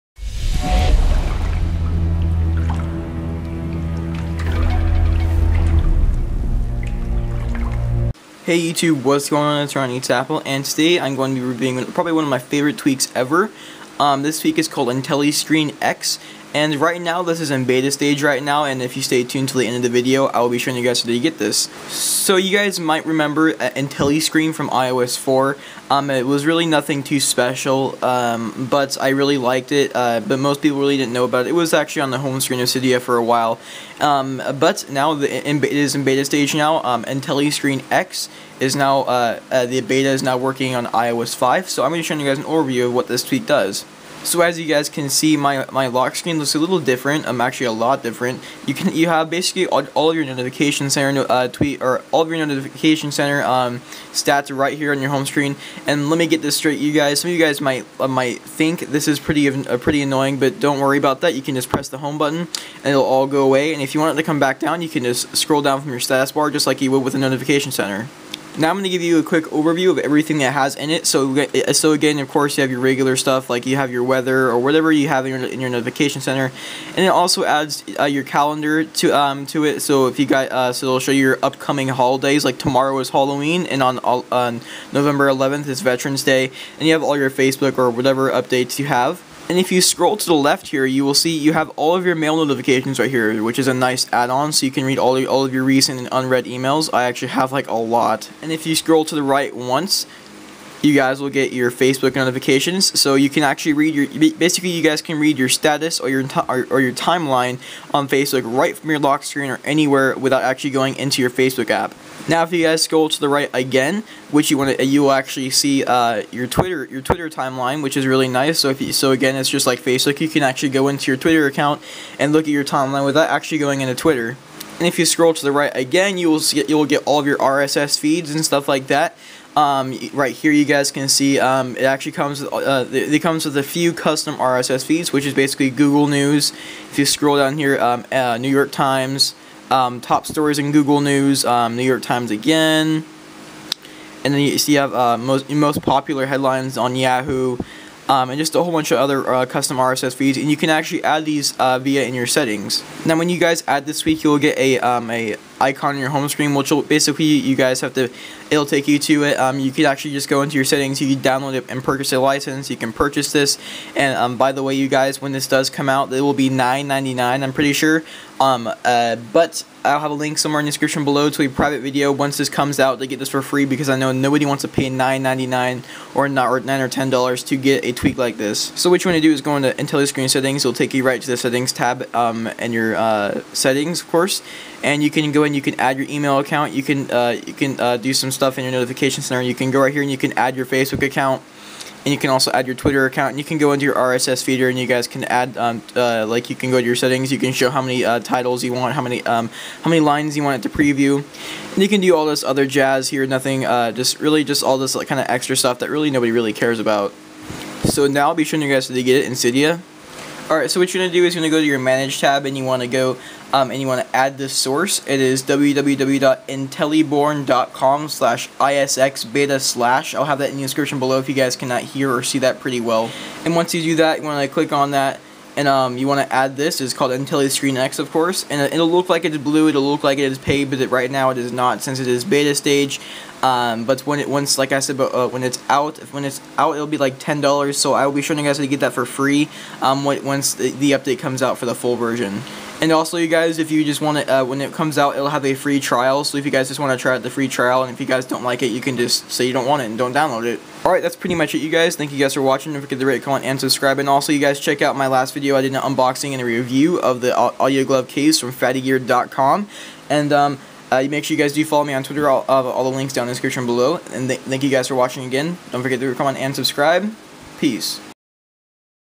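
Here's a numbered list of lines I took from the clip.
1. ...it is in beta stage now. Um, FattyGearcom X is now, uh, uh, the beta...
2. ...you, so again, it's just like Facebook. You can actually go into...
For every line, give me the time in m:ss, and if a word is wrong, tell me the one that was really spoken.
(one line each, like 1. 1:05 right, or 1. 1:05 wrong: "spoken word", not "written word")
1. 0:35 wrong: "IntelliScreen", not "FattyGearcom"
2. 1:58 right.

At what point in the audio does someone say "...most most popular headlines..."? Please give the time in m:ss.
2:25.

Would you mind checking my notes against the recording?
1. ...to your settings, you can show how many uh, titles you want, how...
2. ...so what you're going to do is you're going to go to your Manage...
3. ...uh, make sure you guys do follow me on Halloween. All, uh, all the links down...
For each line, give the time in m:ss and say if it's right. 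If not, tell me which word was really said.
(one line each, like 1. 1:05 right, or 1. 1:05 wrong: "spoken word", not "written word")
1. 3:16 right
2. 3:30 right
3. 4:20 wrong: "Twitter", not "Halloween".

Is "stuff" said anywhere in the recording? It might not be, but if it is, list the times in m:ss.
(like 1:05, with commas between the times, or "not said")
1:13, 2:08, 3:08, 3:25.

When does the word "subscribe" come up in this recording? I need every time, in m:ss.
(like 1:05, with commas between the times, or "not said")
4:13, 4:26.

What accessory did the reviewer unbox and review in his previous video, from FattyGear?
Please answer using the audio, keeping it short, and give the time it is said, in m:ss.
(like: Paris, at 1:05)
Audio Glove case, at 4:17.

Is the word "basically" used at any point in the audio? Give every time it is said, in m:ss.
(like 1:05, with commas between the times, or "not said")
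0:49, 1:44, 2:15, 2:36.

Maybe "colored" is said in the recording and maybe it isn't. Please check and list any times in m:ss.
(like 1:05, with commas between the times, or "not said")
not said.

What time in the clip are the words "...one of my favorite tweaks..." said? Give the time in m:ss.
0:12.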